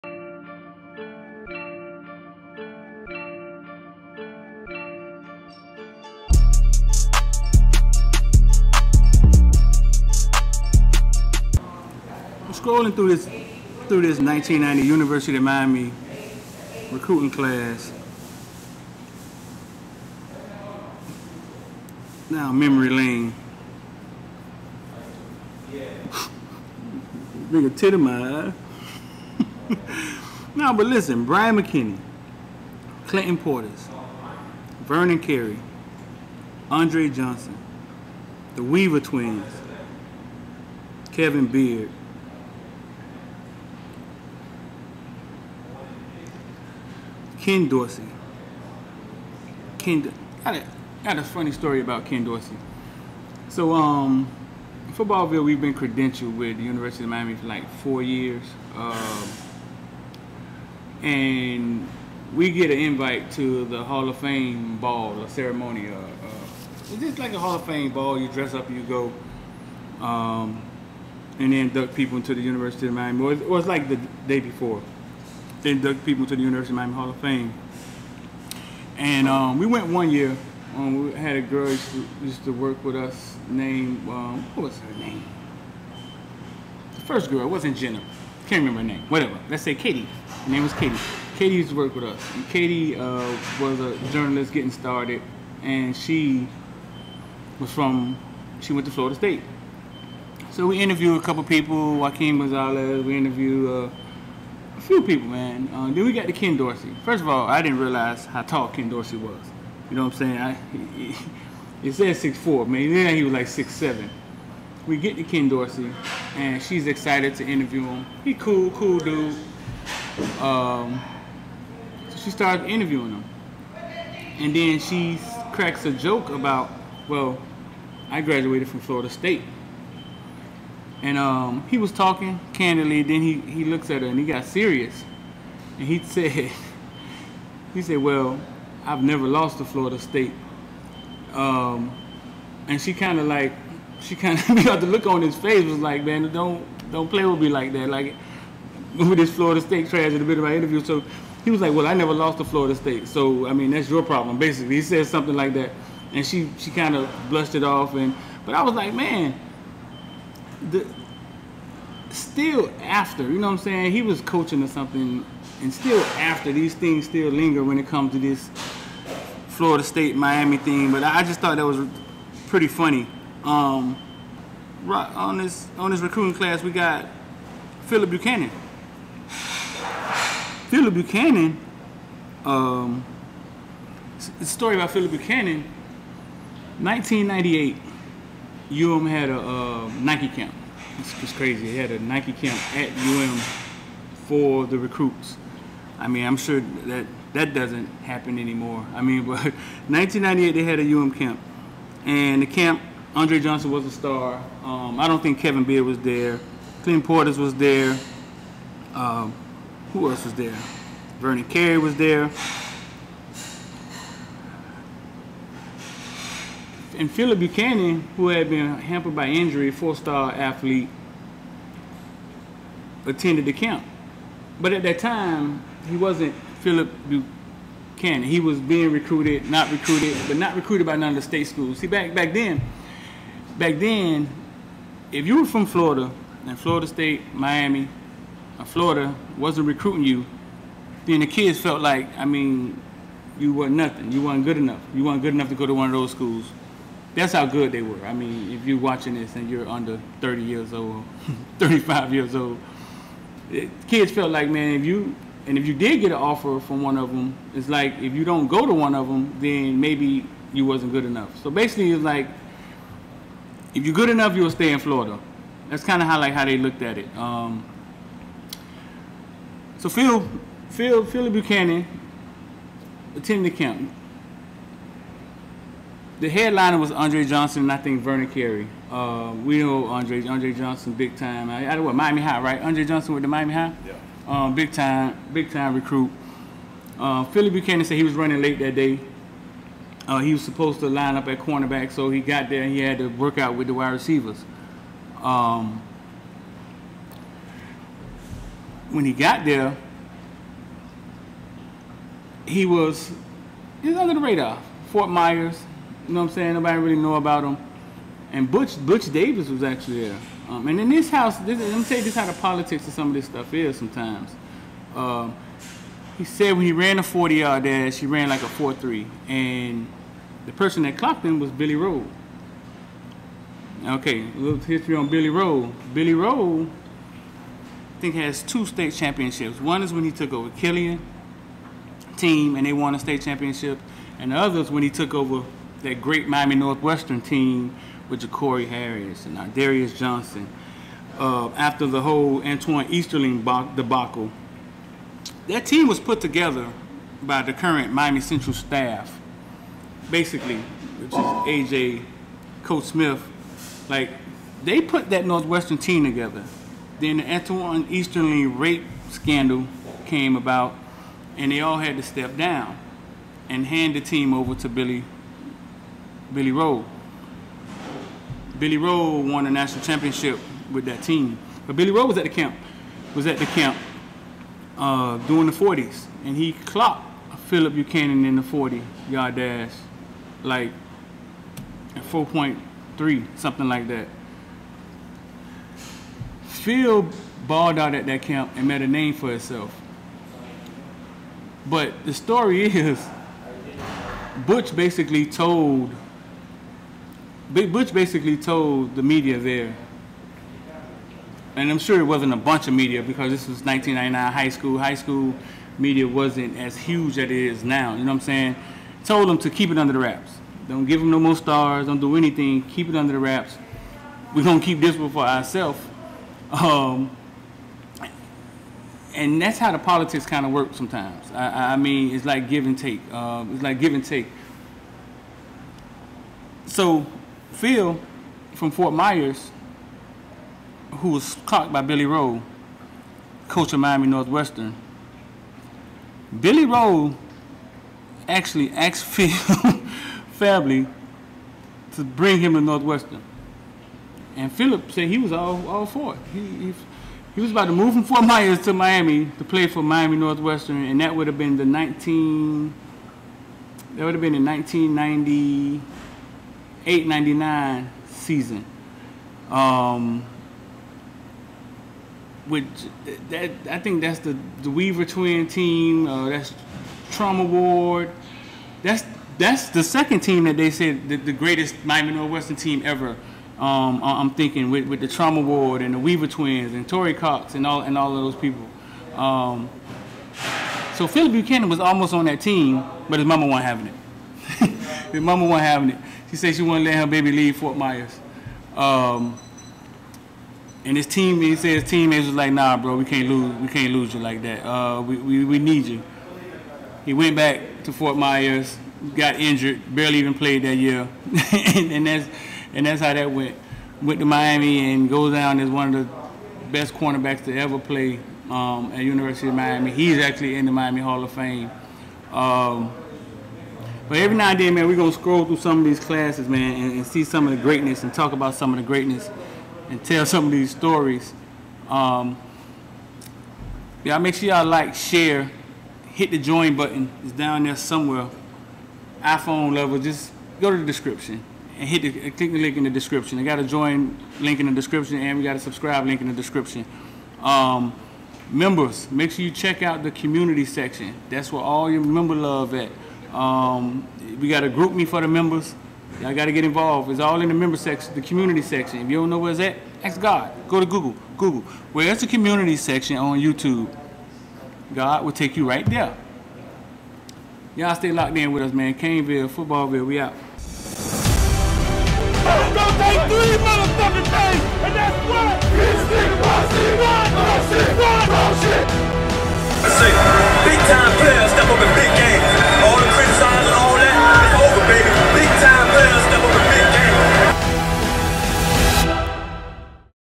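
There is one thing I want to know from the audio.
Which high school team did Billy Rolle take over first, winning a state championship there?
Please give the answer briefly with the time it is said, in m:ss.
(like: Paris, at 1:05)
Killian, at 5:30.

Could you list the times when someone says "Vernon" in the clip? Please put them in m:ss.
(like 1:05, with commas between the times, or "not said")
0:34, 3:31, 4:38.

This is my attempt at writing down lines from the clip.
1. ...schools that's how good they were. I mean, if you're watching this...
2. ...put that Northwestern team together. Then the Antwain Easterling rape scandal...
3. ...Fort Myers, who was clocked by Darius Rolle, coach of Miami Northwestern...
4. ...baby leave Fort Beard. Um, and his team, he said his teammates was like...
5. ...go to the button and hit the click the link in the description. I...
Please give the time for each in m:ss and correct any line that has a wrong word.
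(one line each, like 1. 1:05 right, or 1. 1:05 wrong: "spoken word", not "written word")
1. 4:06 right
2. 5:54 right
3. 7:08 wrong: "Billy", not "Darius"
4. 8:07 wrong: "Myers", not "Beard"
5. 8:50 wrong: "description", not "button".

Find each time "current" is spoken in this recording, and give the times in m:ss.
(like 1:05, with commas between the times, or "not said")
5:47.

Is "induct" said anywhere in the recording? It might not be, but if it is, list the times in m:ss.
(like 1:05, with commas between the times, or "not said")
1:11, 1:15.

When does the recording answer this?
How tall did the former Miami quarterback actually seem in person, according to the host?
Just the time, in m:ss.
1:53.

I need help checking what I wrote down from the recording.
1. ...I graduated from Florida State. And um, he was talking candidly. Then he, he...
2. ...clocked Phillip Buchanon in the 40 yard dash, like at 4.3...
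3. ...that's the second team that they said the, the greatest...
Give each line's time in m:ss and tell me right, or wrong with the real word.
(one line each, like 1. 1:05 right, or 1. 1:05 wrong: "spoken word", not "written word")
1. 2:08 right
2. 6:16 right
3. 7:49 right.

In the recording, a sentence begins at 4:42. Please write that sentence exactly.
Andre Johnson with the Miami High.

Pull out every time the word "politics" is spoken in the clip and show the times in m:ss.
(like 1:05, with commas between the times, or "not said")
5:12, 6:59.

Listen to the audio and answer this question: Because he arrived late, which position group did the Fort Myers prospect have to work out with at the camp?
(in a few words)
Wide receivers.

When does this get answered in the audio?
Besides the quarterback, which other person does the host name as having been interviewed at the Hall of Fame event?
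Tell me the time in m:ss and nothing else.
1:41.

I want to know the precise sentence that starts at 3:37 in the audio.
and Phillip Buchanon, who had been hampered by injury, four-star athlete, attended the camp.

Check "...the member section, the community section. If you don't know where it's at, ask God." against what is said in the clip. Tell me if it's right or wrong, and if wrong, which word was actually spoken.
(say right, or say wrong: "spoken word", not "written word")
right.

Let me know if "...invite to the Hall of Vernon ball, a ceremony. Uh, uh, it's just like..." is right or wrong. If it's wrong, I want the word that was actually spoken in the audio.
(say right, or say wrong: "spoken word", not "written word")
wrong: "Fame", not "Vernon".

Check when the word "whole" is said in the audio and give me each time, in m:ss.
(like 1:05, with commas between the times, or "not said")
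5:42.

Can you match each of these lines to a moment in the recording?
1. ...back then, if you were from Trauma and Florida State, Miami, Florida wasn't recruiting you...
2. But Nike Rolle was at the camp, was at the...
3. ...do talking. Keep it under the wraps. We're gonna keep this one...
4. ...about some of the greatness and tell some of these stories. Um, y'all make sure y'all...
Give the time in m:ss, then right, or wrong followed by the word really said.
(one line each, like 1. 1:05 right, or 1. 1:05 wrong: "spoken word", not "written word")
1. 3:53 wrong: "Florida", not "Trauma"
2. 6:11 wrong: "Billy", not "Nike"
3. 6:51 wrong: "anything", not "talking"
4. 8:38 right.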